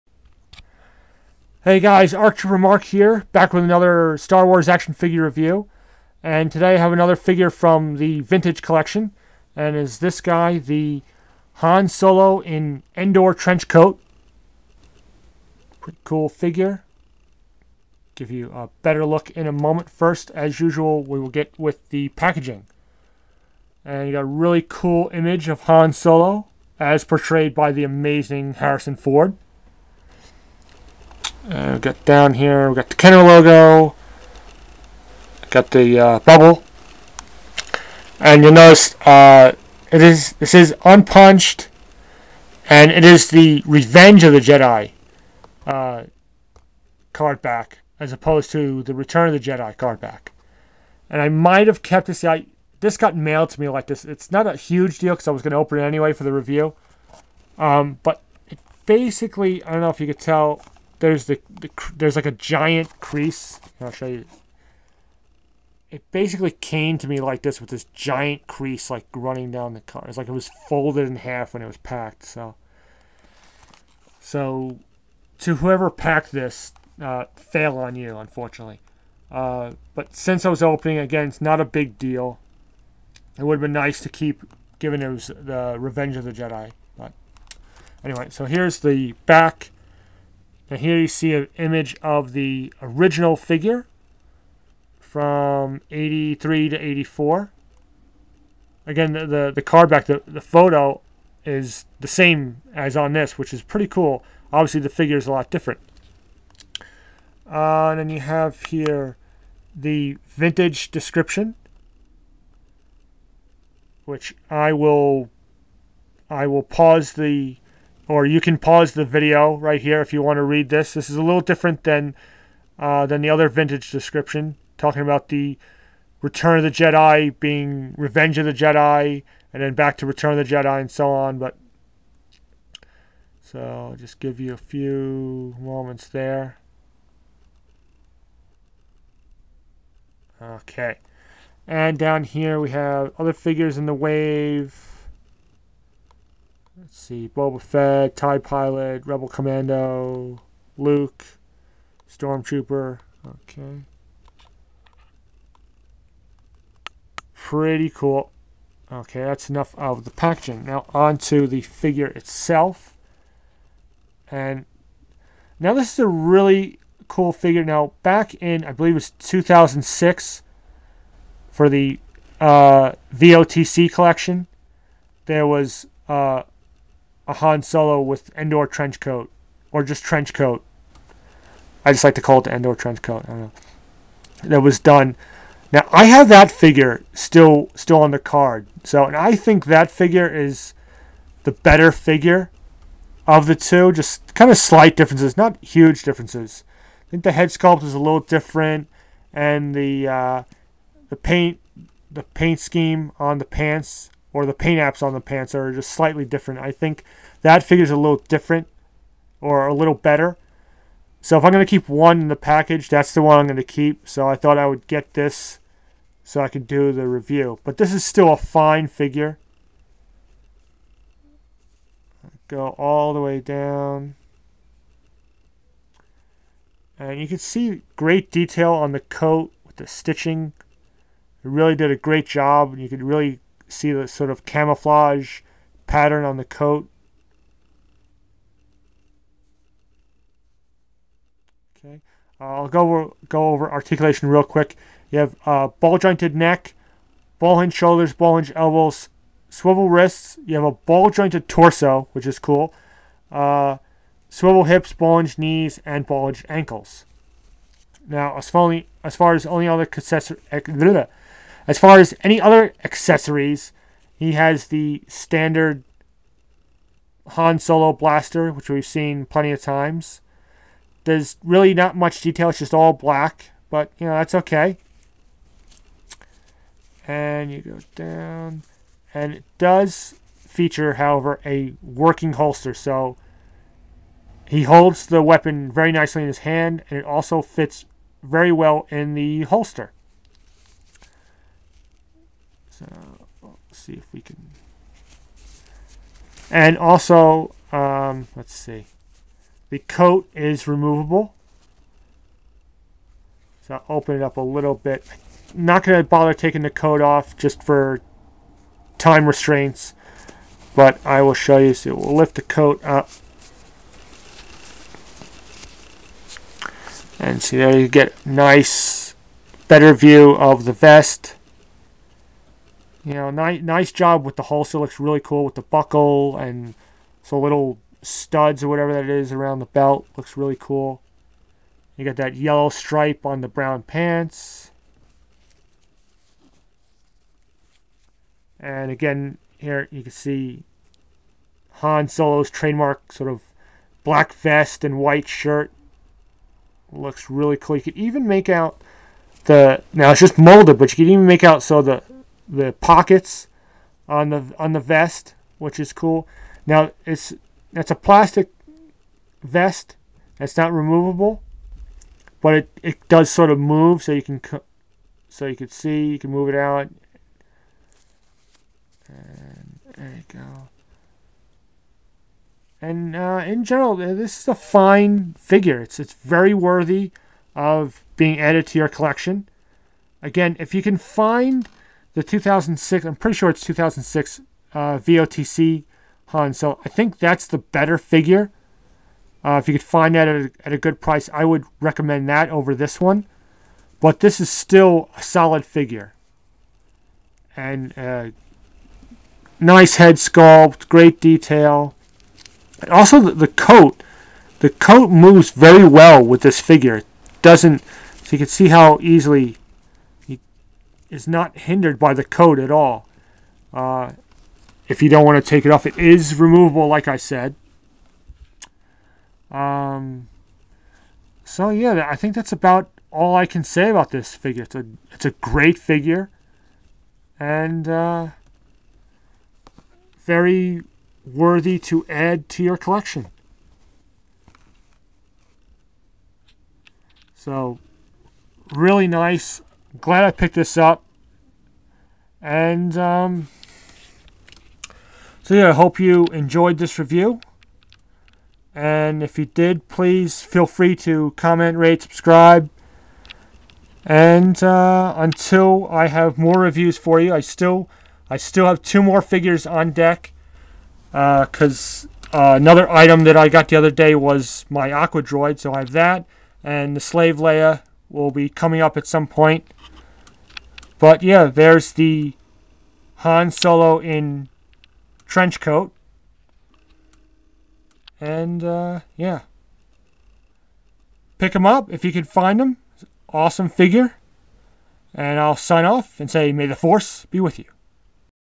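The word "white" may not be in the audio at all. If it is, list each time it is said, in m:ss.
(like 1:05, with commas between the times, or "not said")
5:44.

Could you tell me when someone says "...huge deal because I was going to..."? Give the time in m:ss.
0:54.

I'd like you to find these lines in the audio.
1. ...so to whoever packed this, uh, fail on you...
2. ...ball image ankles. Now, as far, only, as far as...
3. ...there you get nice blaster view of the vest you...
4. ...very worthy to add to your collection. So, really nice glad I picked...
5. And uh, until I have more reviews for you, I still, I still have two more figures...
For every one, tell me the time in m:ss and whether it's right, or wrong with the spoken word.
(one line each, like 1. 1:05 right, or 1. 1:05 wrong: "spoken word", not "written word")
1. 1:14 right
2. 4:16 wrong: "hinge", not "image"
3. 5:17 wrong: "better", not "blaster"
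4. 7:10 right
5. 7:34 right.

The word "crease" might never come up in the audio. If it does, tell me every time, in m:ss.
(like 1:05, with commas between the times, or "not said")
1:03, 1:08.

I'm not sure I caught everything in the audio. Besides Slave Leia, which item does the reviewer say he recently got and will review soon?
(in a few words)
Aqua Droid.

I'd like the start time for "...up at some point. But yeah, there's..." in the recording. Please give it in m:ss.
7:48.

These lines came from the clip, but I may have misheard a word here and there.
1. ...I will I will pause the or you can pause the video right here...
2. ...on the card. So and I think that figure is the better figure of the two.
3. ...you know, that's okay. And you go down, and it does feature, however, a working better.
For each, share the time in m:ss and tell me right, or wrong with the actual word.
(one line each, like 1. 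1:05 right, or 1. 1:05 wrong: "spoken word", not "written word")
1. 1:54 right
2. 3:08 right
3. 4:33 wrong: "holster", not "better".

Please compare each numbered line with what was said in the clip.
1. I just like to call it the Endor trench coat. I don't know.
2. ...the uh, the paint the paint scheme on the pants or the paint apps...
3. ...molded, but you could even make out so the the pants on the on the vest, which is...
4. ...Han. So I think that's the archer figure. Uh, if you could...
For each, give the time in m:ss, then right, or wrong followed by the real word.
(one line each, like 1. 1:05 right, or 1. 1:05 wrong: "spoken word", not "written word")
1. 3:01 right
2. 3:19 right
3. 5:50 wrong: "pockets", not "pants"
4. 6:26 wrong: "better", not "archer".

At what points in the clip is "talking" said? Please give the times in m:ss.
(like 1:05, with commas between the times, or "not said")
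2:04.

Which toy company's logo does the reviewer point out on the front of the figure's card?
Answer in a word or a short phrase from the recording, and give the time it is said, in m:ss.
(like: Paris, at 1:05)
Kenner, at 0:32.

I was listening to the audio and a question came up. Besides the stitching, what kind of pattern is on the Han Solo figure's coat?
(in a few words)
Camouflage.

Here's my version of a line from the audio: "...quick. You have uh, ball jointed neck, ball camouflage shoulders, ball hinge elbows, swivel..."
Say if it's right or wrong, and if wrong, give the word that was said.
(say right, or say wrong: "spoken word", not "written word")
wrong: "hinge", not "camouflage".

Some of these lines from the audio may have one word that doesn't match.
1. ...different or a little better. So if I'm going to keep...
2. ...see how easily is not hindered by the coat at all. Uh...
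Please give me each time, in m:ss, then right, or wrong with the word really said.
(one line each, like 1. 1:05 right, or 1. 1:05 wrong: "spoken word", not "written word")
1. 3:28 right
2. 6:48 right.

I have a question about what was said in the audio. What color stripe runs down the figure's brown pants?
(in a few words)
Yellow.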